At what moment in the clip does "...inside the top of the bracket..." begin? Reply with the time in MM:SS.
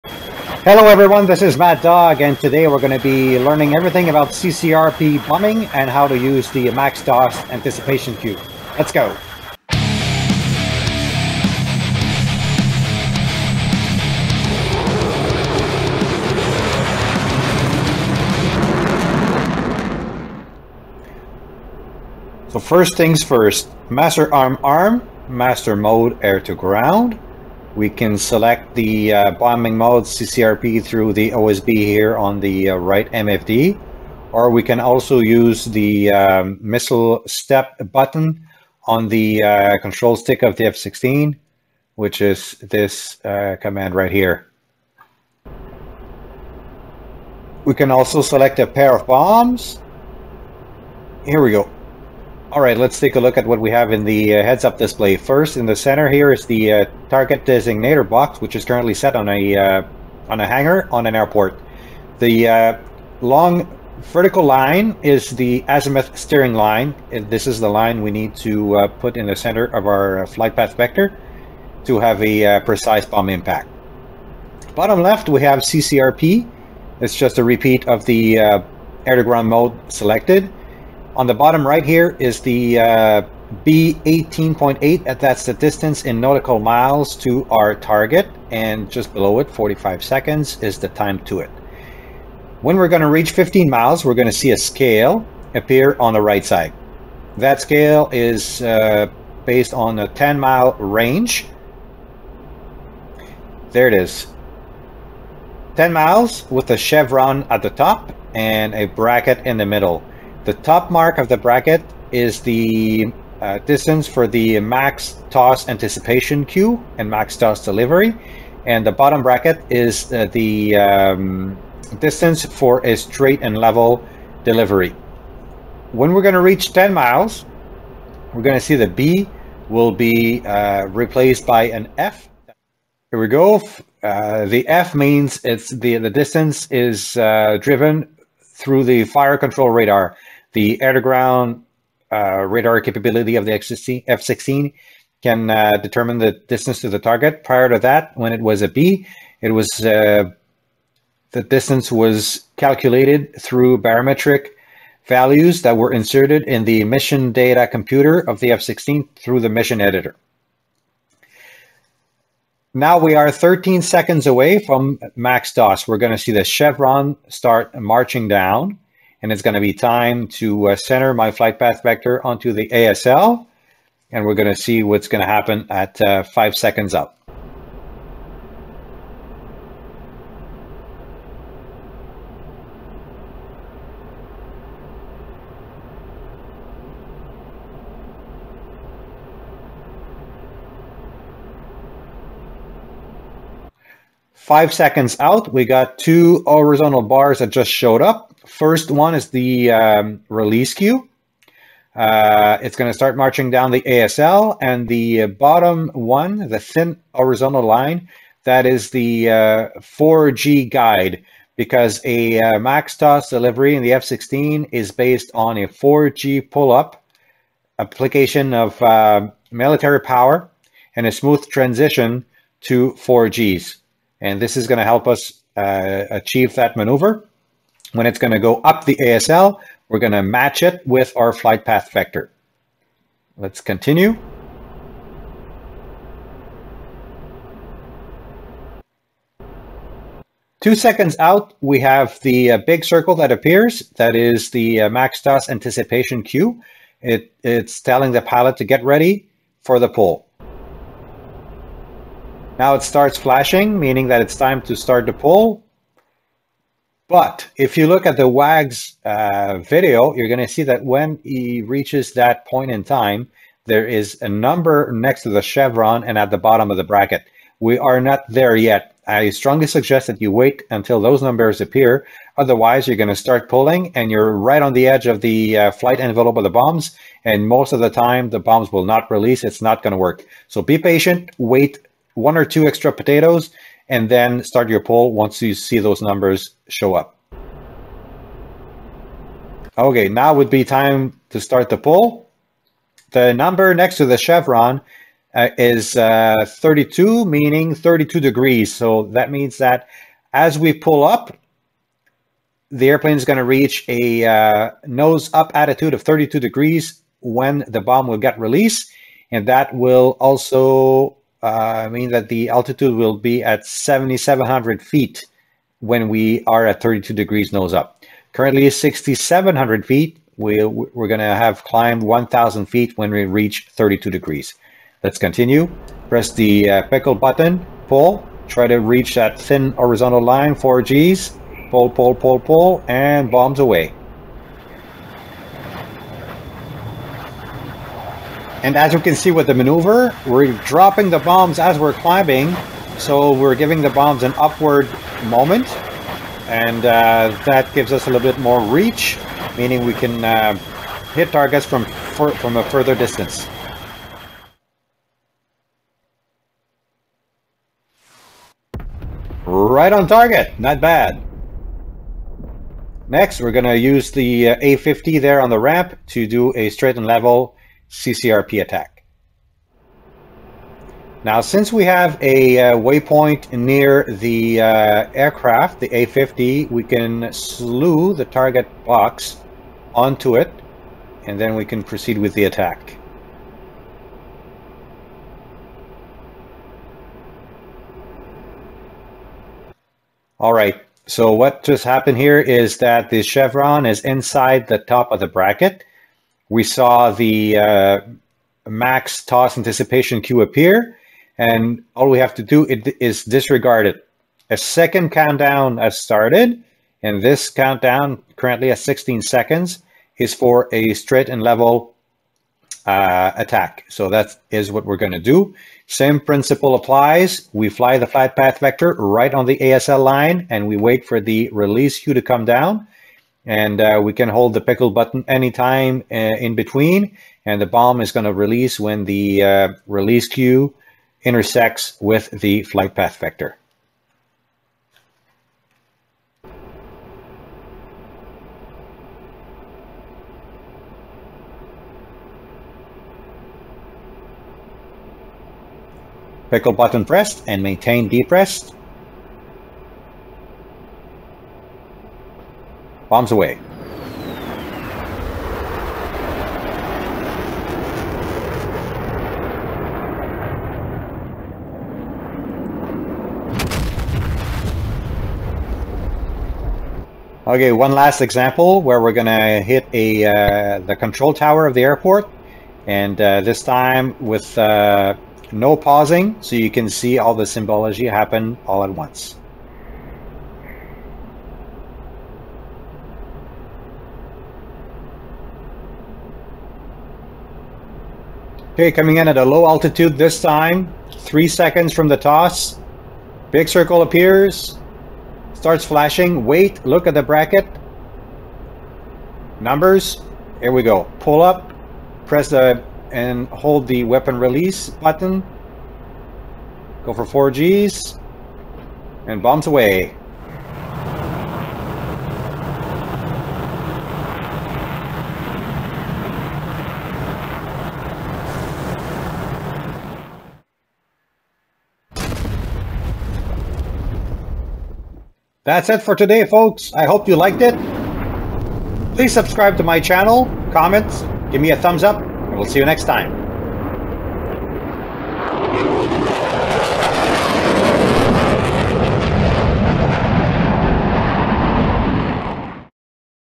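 06:34.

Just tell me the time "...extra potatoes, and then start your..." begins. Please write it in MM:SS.
04:42.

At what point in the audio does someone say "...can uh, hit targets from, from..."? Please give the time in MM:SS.
05:49.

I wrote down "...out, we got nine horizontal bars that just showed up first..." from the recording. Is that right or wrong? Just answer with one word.
wrong.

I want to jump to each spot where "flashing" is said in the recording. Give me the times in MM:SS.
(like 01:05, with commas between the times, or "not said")
04:13, 08:15.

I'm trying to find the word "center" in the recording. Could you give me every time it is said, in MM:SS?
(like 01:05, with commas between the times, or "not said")
00:55, 01:09, 02:50.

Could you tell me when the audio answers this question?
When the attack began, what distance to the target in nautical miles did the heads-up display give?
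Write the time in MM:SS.
01:23.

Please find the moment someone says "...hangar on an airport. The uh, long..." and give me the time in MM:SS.
01:00.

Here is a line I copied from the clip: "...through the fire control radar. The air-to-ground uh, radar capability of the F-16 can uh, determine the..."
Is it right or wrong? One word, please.
right.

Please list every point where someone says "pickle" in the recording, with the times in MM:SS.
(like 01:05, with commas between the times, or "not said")
05:26, 07:04, 07:26.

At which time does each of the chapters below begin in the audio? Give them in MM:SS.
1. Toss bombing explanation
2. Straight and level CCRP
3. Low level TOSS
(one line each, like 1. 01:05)
1. 00:20
2. 06:10
3. 08:00.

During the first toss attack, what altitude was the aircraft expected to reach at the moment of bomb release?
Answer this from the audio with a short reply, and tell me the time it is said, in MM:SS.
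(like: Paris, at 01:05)
7,700 feet, at 05:13.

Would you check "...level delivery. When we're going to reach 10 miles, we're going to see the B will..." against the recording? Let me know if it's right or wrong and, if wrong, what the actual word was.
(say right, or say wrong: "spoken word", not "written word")
right.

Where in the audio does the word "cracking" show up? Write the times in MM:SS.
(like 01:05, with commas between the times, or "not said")
not said.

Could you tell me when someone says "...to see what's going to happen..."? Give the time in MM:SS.
02:54.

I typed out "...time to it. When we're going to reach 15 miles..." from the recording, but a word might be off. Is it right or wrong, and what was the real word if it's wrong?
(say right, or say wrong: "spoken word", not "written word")
right.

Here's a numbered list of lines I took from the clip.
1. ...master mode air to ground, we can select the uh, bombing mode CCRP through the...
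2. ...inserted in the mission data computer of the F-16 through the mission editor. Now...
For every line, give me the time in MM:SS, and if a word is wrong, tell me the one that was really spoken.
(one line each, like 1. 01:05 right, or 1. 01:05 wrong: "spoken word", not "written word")
1. 00:25 right
2. 02:35 right.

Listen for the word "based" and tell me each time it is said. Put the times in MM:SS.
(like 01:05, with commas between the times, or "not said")
01:39, 03:34.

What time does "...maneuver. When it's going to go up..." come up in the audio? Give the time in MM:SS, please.
03:46.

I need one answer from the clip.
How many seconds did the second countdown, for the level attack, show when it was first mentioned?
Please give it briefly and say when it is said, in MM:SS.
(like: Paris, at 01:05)
16 seconds, at 06:48.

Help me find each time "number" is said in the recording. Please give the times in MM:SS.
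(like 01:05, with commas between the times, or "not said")
04:24, 04:31, 04:46, 04:53, 08:19.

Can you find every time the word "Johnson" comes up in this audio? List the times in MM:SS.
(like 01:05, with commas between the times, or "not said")
not said.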